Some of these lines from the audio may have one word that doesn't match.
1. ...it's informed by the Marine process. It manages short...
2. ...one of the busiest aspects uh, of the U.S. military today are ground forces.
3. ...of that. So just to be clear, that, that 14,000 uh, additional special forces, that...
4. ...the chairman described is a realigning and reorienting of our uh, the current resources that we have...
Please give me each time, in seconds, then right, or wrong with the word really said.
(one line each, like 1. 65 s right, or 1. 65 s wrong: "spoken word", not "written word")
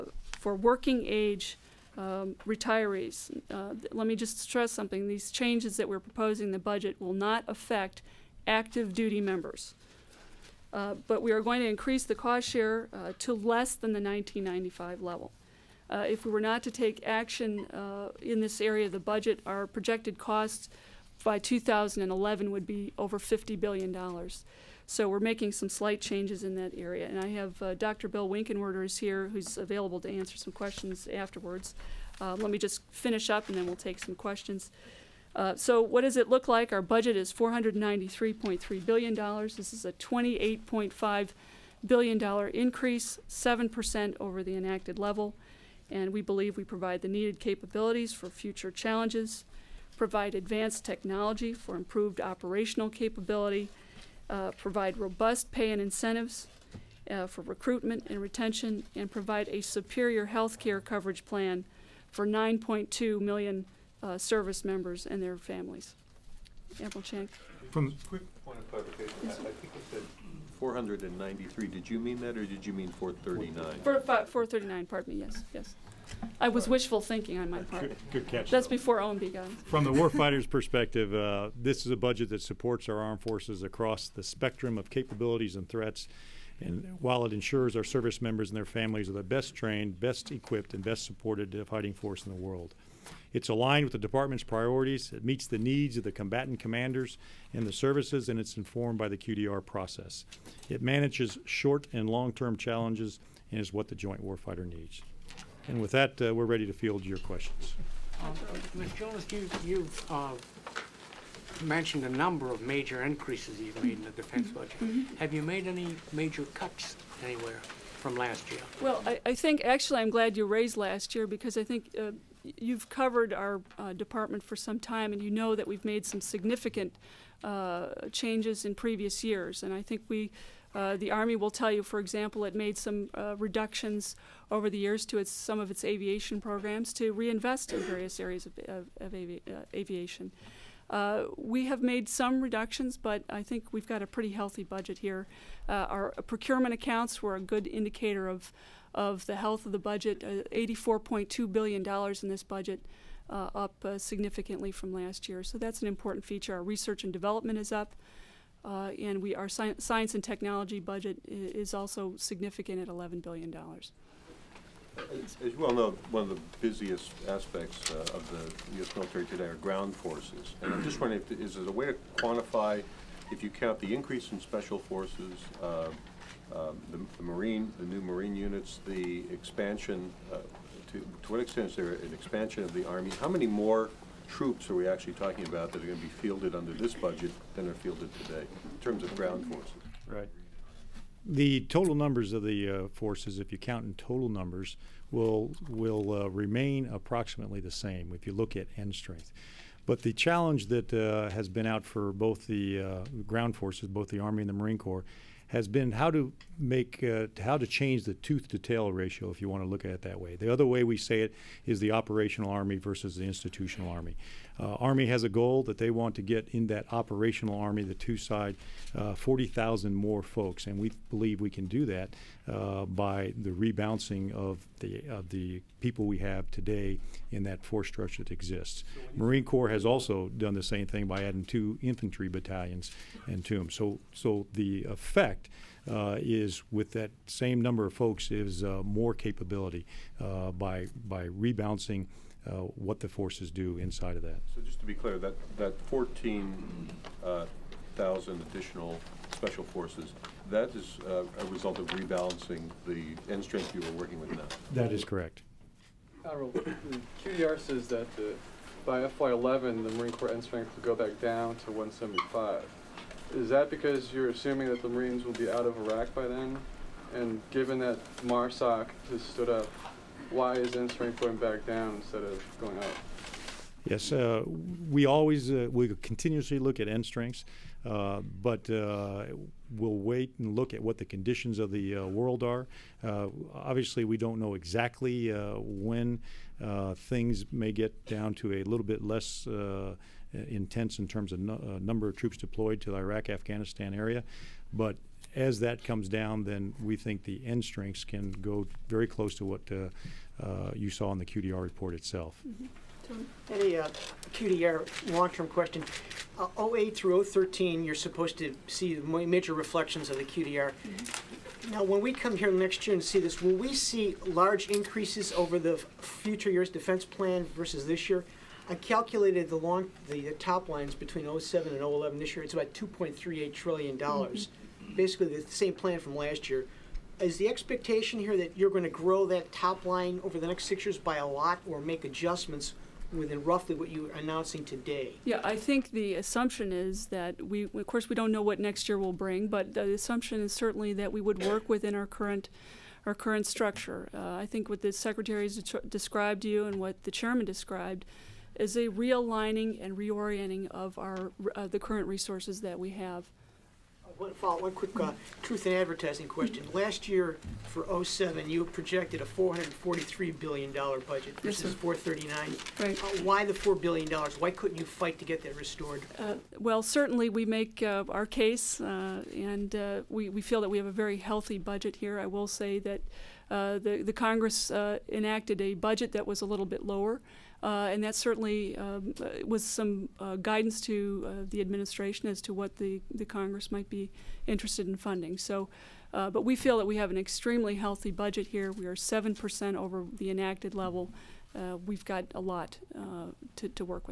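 1. 98 s wrong: "QDR", not "Marine"
2. 166 s right
3. 244 s right
4. 347 s right.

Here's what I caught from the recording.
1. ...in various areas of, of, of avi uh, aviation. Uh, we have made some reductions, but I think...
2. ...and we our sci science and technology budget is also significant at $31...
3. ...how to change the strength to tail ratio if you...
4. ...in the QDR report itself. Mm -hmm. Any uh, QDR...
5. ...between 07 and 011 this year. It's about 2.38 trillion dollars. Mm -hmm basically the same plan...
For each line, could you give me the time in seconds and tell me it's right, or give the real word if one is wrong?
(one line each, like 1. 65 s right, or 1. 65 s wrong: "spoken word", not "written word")
1. 137 s right
2. 159 s wrong: "11", not "31"
3. 207 s wrong: "tooth", not "strength"
4. 301 s right
5. 321 s right.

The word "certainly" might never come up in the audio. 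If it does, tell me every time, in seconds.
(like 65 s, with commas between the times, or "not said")
340 s, 366 s, 378 s.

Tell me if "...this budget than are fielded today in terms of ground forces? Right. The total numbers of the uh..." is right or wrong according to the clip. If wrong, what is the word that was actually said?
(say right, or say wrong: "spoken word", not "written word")
right.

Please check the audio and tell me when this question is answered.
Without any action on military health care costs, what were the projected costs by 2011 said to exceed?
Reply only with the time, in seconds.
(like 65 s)
23 s.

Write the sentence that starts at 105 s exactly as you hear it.
And with that, uh, we're ready to field your questions.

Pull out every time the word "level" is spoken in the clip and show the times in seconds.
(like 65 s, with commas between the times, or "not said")
15 s, 44 s, 390 s.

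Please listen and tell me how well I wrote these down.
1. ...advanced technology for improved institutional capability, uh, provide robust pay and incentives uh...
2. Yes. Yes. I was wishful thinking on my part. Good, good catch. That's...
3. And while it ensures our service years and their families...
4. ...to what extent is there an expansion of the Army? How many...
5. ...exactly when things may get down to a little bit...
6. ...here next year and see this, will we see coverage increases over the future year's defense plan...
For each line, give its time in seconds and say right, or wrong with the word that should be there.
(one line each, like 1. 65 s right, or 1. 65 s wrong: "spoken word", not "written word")
1. 50 s wrong: "operational", not "institutional"
2. 75 s right
3. 86 s wrong: "members", not "years"
4. 181 s right
5. 284 s right
6. 312 s wrong: "large", not "coverage".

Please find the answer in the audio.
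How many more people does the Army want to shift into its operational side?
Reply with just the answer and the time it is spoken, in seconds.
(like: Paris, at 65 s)
40,000, at 219 s.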